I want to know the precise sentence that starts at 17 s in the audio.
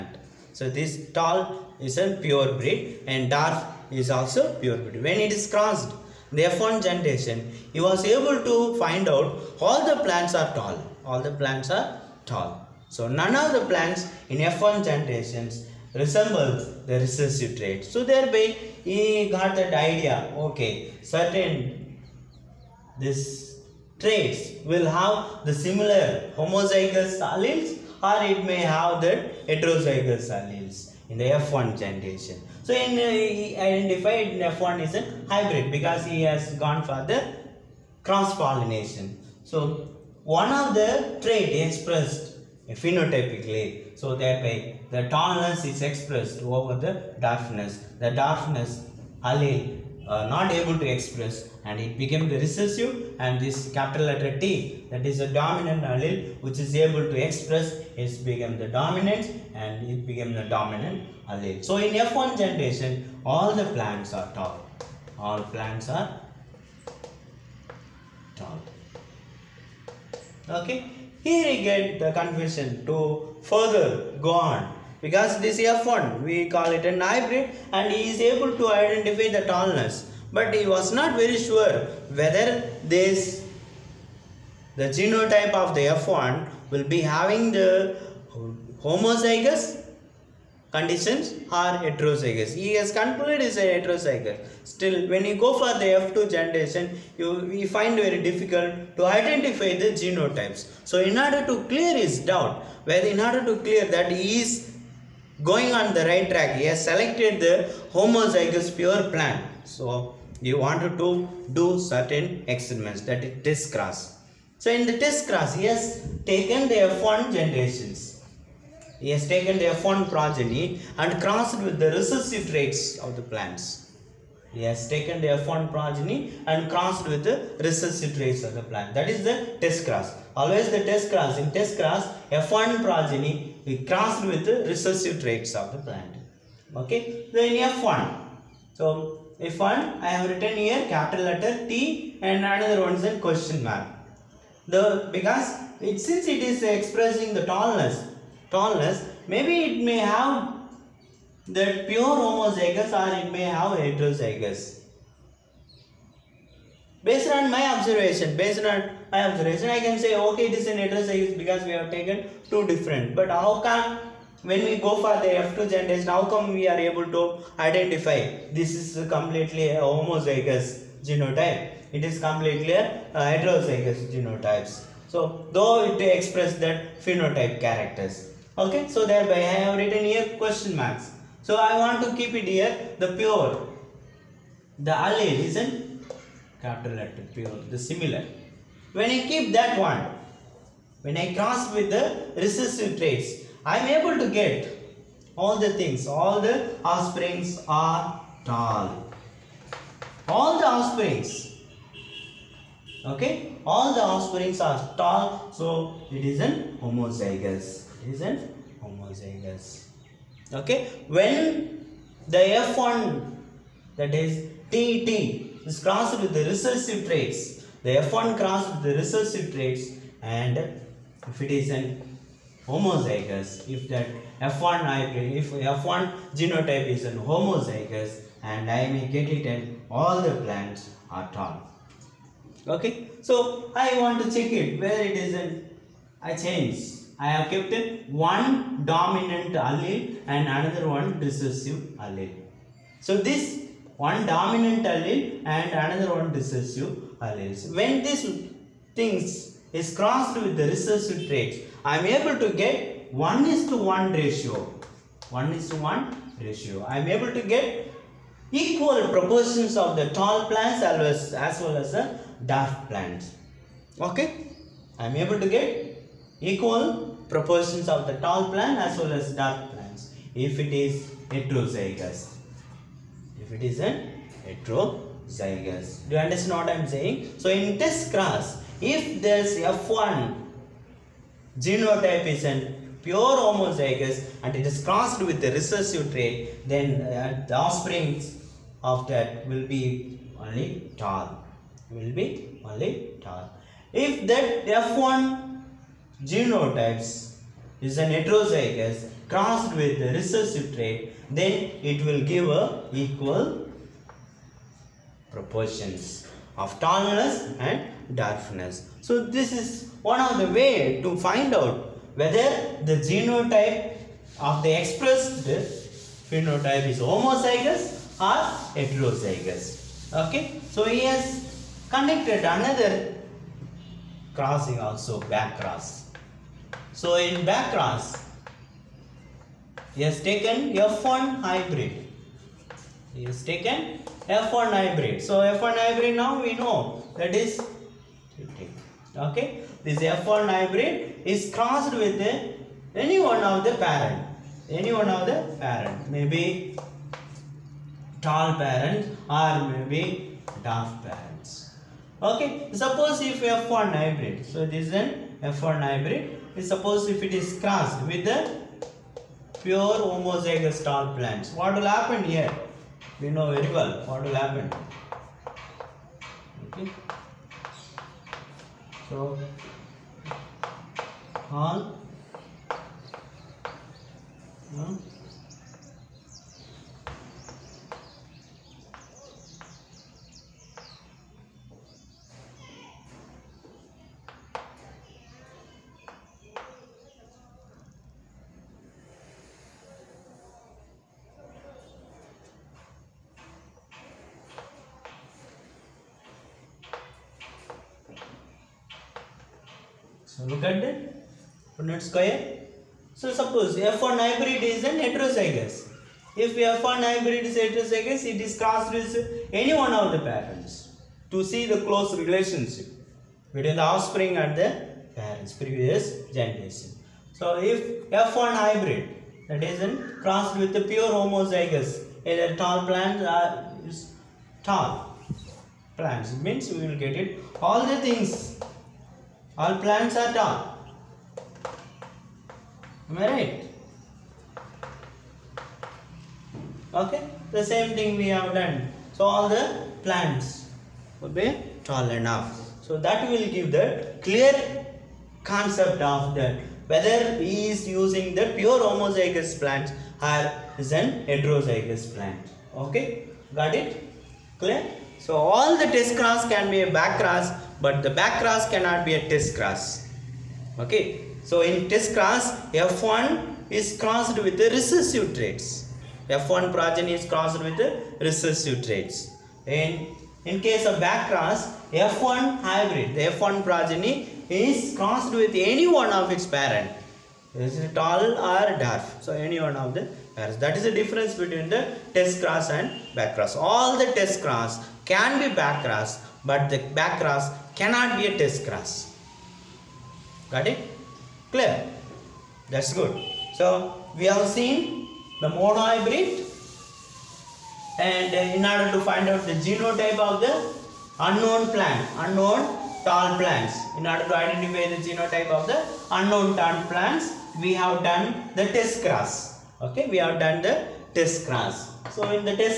So thereby he got that idea.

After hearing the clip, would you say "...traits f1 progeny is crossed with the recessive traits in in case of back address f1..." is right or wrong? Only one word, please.
wrong.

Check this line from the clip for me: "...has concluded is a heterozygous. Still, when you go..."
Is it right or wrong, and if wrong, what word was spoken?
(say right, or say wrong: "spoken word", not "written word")
right.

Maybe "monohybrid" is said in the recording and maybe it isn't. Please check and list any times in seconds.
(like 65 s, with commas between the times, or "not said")
495 s.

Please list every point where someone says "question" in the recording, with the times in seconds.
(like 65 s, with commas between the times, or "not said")
143 s, 180 s.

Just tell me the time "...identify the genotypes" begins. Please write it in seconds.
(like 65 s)
99 s.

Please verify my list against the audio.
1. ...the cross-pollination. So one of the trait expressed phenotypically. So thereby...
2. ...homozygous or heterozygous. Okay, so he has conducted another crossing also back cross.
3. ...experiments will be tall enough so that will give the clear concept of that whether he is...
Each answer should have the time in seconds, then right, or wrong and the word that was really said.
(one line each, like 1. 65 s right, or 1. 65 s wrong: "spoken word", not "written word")
1. 37 s right
2. 317 s right
3. 440 s wrong: "plants", not "experiments".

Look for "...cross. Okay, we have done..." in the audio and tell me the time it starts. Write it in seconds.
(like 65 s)
509 s.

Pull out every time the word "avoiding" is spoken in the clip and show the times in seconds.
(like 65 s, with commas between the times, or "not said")
not said.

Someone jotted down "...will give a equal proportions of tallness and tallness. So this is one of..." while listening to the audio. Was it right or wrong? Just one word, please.
wrong.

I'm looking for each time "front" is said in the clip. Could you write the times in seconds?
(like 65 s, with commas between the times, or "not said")
not said.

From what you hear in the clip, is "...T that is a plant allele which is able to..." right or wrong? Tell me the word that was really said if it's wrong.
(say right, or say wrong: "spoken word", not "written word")
wrong: "dominant", not "plant".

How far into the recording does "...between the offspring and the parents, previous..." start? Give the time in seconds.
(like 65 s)
413 s.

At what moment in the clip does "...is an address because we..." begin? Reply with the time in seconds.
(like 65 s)
160 s.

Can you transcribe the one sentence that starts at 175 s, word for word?
So, though it express that phenotype characters.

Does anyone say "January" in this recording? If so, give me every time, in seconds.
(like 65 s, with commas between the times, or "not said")
not said.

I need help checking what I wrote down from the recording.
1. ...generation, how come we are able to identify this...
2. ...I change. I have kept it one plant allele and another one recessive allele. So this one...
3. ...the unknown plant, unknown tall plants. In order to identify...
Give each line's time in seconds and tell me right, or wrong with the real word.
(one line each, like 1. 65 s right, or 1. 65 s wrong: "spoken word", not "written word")
1. 165 s right
2. 236 s wrong: "dominant", not "plant"
3. 500 s right.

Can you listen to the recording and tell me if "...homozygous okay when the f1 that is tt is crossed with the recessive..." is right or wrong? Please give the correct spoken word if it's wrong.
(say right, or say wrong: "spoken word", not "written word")
right.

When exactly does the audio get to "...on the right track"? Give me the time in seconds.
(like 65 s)
105 s.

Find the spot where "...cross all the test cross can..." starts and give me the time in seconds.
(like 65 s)
483 s.